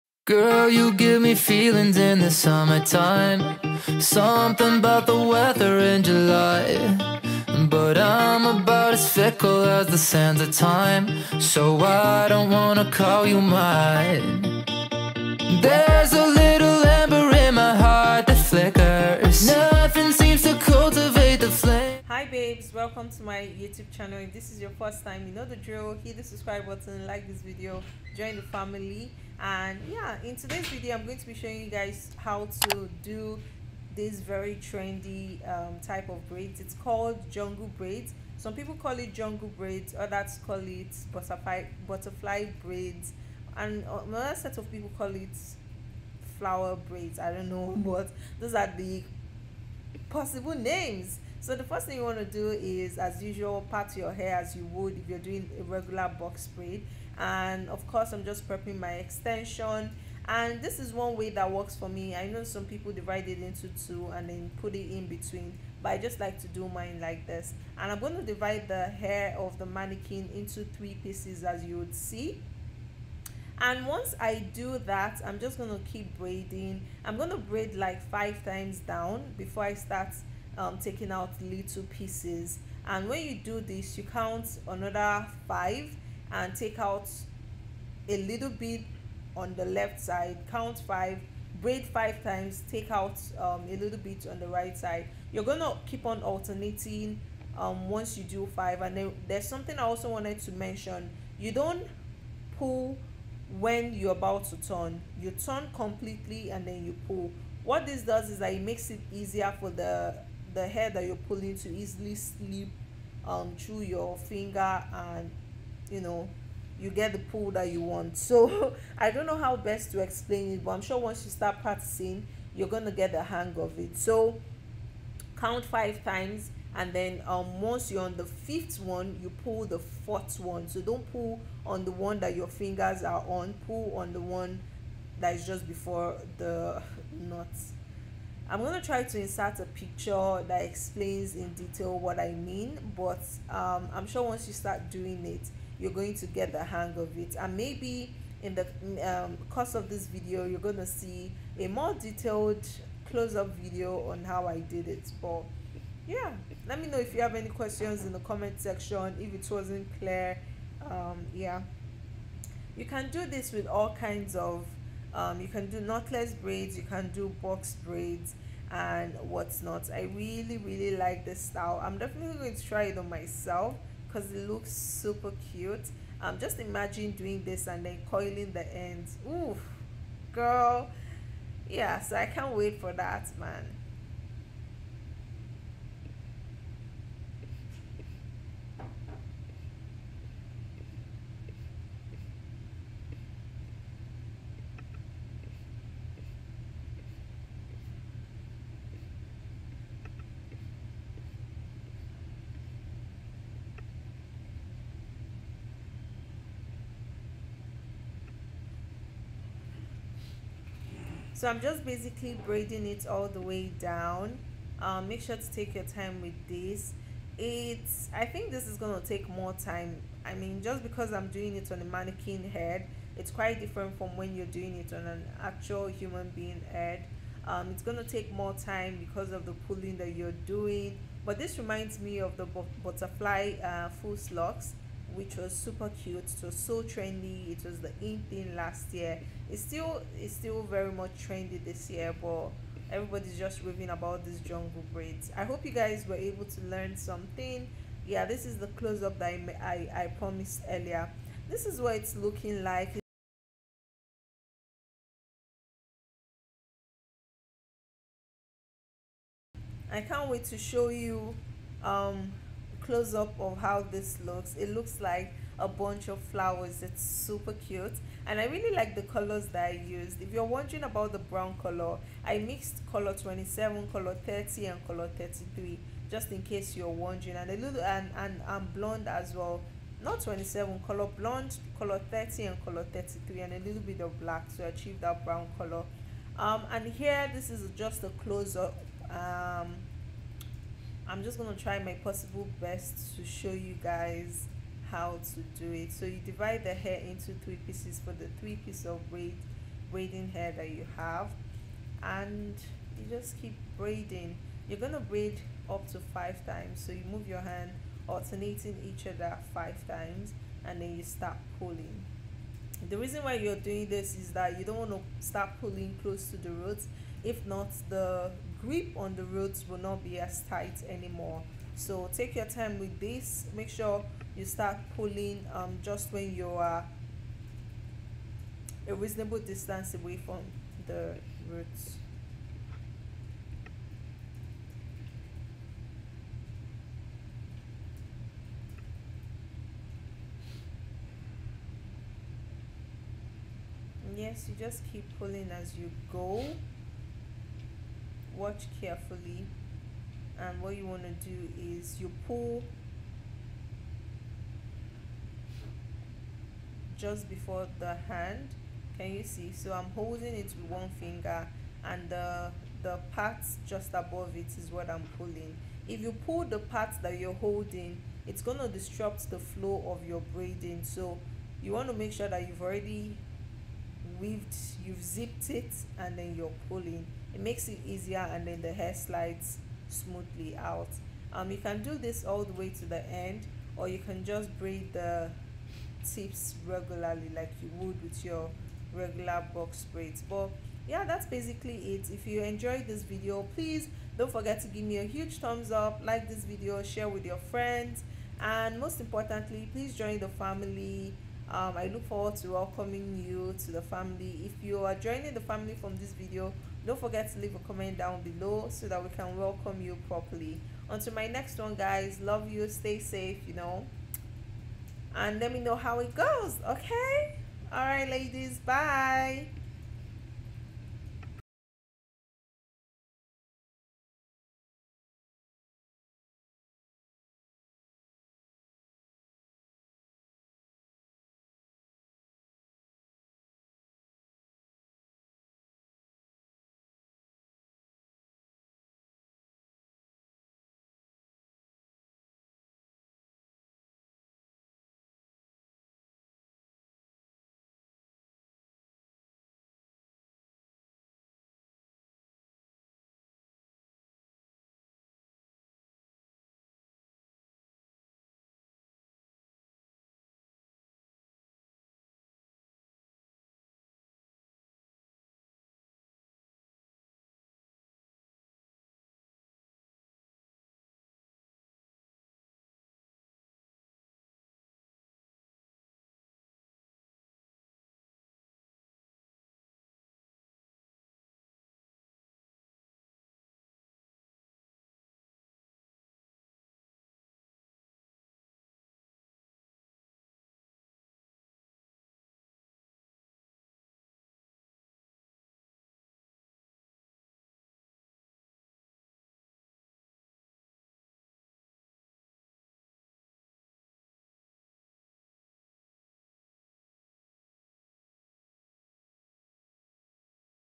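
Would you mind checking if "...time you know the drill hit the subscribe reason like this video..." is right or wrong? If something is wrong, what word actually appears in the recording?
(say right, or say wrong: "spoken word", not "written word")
wrong: "button", not "reason".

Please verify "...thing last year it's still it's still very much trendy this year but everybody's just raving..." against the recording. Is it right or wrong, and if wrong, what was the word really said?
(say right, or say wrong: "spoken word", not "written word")
right.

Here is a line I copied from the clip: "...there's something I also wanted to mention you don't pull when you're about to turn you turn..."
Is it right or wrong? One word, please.
right.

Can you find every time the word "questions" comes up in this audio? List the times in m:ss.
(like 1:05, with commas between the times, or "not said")
2:37.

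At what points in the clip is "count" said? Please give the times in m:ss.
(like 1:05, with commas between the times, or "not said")
1:24, 1:30, 2:05.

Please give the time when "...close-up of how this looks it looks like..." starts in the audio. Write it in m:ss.
4:22.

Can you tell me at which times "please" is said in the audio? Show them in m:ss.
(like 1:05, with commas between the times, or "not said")
6:33, 6:39.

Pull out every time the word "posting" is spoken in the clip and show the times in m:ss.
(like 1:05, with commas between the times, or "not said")
not said.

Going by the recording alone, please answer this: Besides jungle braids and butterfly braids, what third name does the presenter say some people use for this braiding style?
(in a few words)
flower braids.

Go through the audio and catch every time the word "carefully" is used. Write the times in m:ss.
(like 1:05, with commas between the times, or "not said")
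5:48.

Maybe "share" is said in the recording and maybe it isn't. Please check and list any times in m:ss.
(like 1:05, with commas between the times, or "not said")
6:36.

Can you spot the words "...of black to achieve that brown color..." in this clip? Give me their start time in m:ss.
4:44.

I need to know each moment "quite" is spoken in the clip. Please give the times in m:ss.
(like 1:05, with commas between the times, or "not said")
3:43.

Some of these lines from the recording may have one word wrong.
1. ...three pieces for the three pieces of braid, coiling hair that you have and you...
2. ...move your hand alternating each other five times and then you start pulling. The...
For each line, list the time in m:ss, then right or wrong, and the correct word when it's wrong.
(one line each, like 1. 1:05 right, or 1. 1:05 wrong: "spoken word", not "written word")
1. 4:57 wrong: "braiding", not "coiling"
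2. 5:07 right.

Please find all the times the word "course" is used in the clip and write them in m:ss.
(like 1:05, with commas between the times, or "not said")
0:57, 2:29.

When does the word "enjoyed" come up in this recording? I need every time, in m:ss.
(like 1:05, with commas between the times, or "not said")
6:32.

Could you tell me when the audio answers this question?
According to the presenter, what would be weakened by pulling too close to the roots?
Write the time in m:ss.
5:18.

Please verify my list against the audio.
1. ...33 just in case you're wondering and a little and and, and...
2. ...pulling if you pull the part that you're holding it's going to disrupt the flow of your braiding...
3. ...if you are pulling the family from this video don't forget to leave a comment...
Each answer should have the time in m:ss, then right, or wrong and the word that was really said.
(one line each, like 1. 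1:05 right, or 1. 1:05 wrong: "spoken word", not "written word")
1. 4:35 right
2. 6:05 right
3. 6:44 wrong: "joining", not "pulling".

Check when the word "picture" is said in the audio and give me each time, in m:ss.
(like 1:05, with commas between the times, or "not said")
2:19.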